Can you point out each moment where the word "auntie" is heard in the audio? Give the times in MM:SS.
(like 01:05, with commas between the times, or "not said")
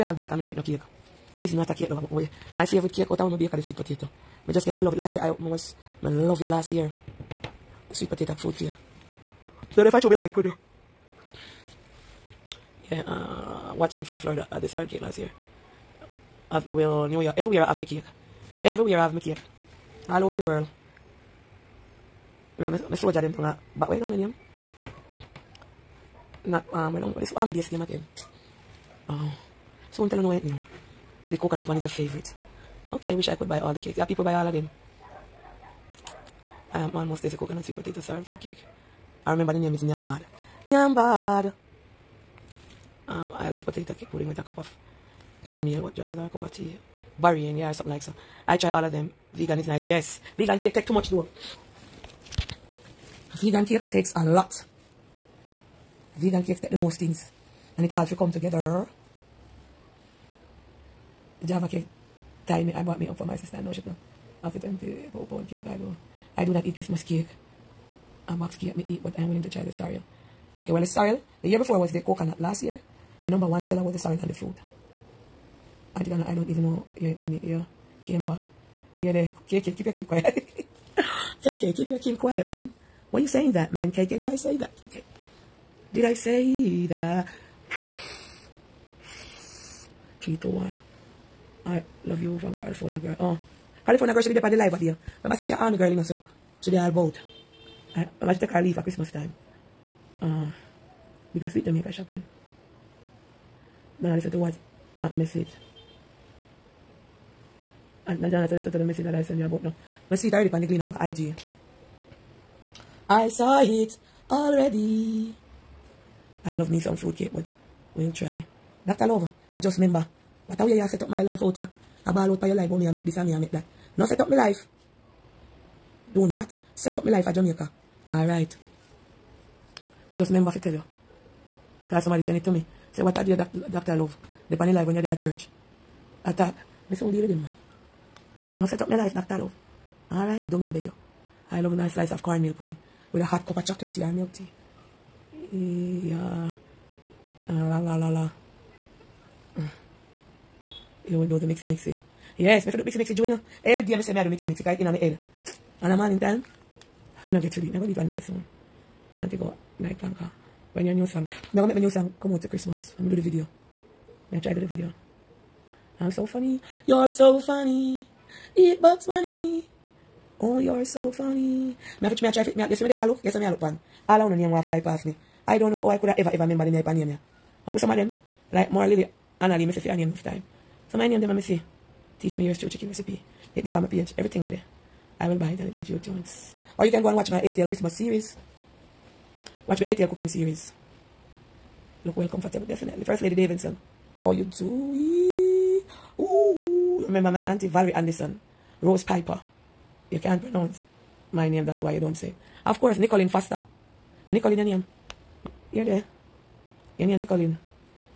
01:15, 03:17.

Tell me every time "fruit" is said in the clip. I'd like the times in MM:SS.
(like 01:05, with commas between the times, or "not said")
00:38, 01:14.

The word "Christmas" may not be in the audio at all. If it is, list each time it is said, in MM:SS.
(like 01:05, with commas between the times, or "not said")
01:06, 01:38, 02:42, 03:07.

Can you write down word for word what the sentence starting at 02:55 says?
I don't know how I could have ever, ever remember them I pan ya.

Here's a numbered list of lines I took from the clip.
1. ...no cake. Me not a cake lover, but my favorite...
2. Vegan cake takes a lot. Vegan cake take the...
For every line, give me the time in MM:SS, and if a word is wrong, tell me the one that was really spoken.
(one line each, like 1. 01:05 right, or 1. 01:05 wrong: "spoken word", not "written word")
1. 00:00 right
2. 00:53 right.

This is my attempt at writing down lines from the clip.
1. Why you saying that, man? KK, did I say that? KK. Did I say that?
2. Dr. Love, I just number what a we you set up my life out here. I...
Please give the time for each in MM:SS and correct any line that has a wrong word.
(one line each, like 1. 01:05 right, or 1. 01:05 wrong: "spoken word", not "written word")
1. 01:23 right
2. 01:58 wrong: "remember", not "number".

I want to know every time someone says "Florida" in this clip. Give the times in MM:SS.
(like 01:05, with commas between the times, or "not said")
00:14.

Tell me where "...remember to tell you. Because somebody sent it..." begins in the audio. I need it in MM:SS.
02:10.